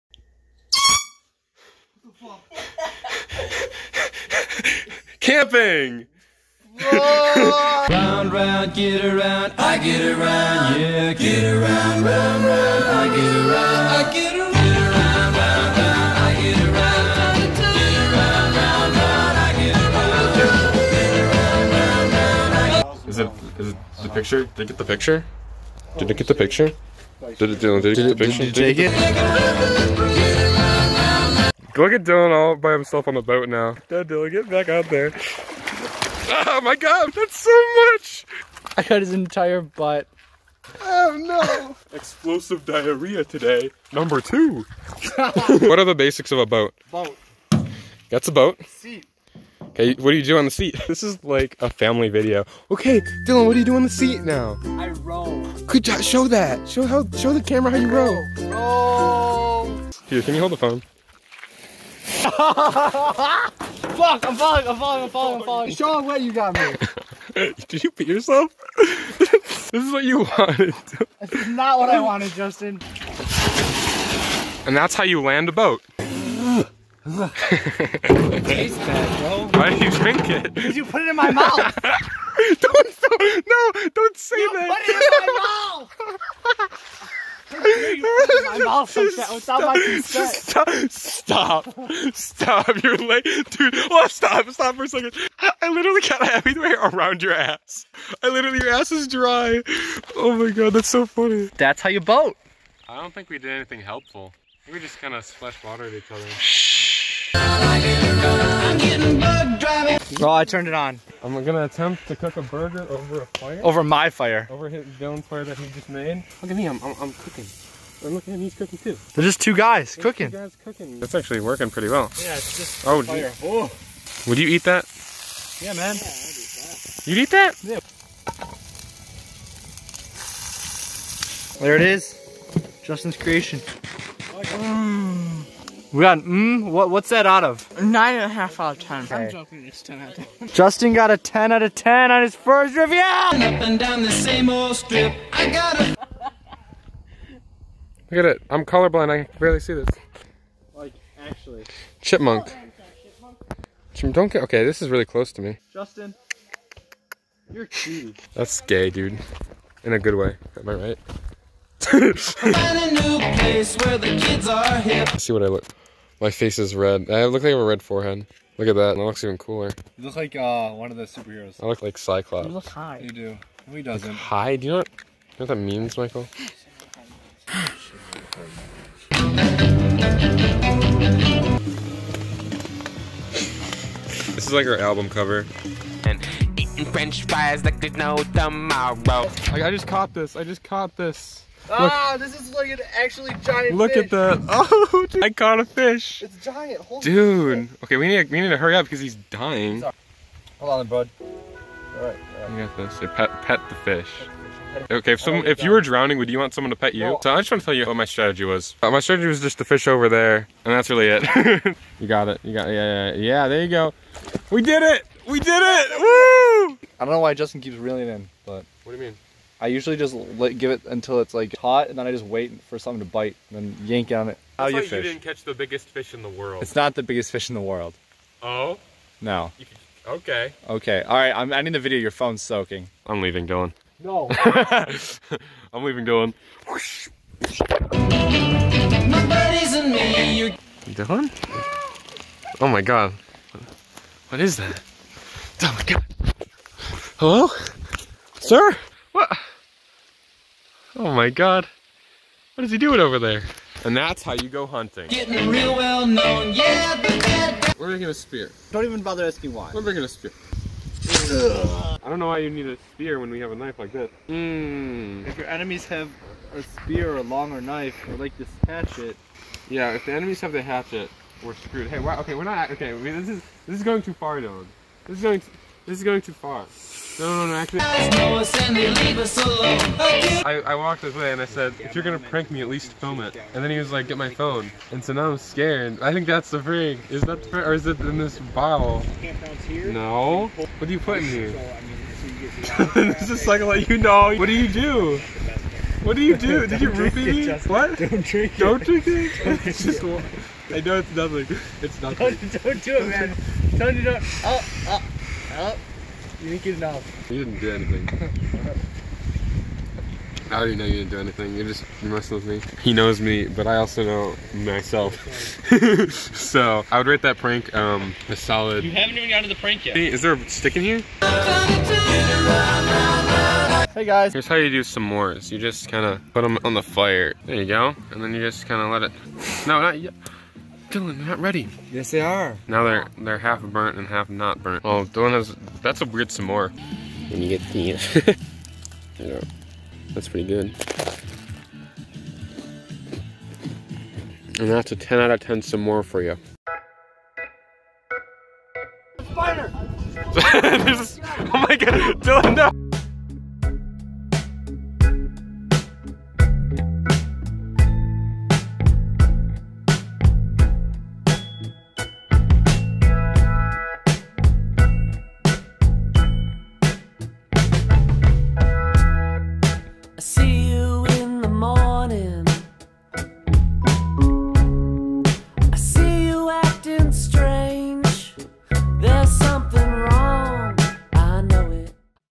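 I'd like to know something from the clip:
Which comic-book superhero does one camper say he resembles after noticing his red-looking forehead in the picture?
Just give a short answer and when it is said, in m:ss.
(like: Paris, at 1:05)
Cyclops, at 2:51.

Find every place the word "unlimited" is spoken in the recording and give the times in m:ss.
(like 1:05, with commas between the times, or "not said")
not said.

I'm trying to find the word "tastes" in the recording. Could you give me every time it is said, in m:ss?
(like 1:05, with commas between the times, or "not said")
1:18.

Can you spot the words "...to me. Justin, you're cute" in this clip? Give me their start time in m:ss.
2:35.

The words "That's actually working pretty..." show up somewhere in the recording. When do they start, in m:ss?
2:00.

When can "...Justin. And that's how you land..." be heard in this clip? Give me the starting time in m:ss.
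1:12.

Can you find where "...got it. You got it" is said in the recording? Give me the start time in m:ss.
3:32.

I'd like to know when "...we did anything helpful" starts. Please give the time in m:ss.
1:43.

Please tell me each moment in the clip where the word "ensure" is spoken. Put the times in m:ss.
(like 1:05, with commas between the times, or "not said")
not said.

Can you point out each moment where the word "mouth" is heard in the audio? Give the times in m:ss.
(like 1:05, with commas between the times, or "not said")
1:21, 1:28.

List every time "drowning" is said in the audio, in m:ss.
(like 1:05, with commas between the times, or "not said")
3:25.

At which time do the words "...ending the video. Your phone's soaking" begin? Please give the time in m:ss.
3:51.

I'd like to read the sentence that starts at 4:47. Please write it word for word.
Is that the prank, or is it in this bottle?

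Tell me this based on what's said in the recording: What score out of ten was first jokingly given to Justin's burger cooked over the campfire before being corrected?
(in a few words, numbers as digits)
9.5.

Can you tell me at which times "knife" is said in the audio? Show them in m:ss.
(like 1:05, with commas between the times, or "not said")
4:23, 4:27.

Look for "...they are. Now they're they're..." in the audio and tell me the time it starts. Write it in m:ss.
5:32.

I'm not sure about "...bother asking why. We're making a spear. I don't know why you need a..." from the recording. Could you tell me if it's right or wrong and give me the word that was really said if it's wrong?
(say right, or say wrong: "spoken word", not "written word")
right.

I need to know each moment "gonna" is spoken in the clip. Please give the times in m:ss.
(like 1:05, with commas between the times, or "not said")
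1:51, 4:42.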